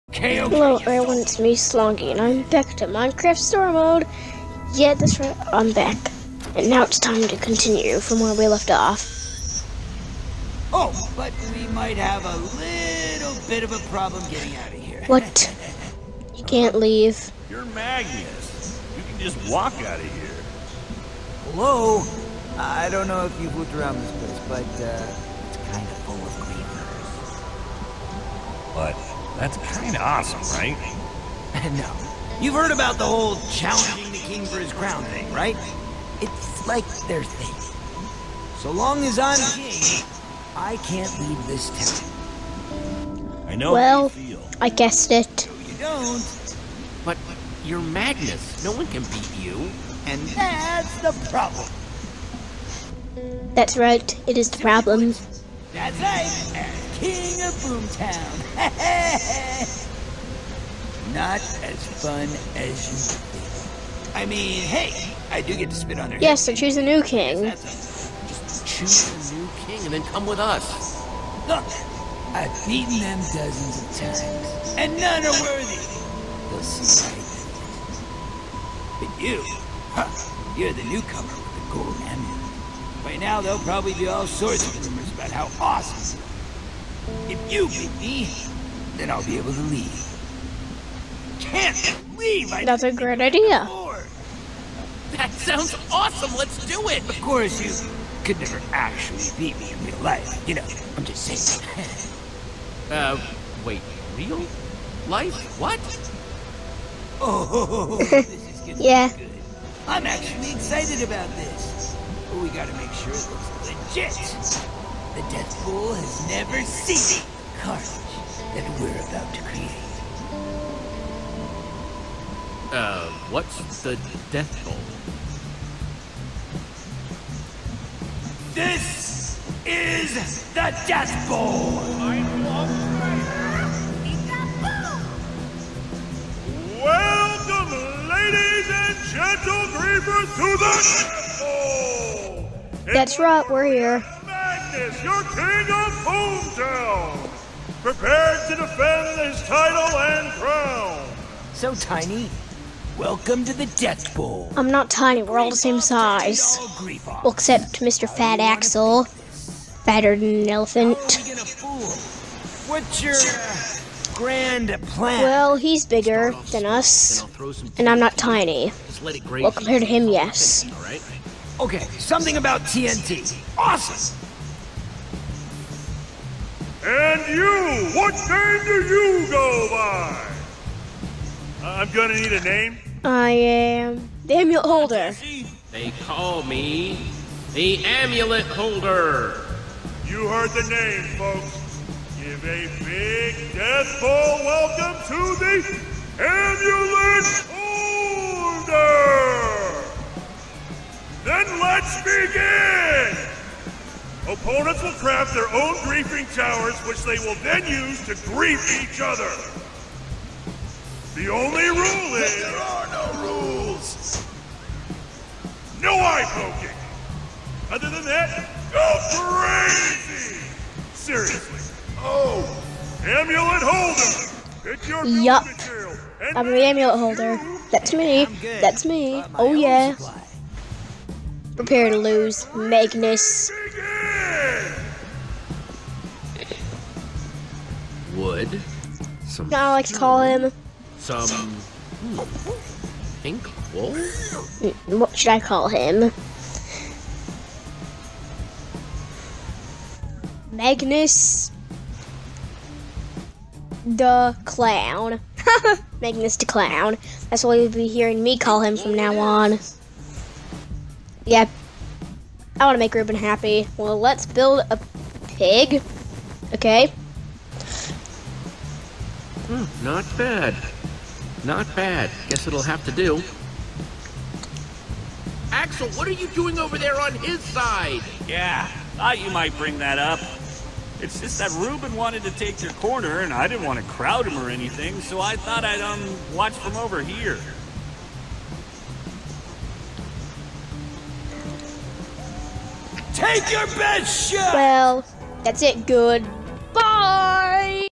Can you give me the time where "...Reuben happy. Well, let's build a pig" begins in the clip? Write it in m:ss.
4:22.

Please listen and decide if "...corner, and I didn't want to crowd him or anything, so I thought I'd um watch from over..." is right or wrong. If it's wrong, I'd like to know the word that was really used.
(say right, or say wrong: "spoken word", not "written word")
right.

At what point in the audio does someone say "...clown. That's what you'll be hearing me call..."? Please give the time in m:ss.
4:16.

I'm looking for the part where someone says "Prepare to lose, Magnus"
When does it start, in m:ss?
3:51.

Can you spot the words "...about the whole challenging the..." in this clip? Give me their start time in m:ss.
0:32.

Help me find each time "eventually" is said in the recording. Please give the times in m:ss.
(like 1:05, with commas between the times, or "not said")
not said.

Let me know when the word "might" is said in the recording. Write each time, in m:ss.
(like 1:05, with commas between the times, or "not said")
0:11, 4:39.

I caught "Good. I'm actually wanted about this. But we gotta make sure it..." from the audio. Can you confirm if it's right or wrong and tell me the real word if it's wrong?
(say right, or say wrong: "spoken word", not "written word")
wrong: "excited", not "wanted".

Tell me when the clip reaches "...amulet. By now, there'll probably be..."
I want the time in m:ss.
1:22.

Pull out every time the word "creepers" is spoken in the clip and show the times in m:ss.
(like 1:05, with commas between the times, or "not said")
0:26, 2:19.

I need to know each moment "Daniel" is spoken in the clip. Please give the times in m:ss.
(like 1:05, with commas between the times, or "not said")
3:04.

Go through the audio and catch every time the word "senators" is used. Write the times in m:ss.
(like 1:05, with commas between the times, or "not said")
not said.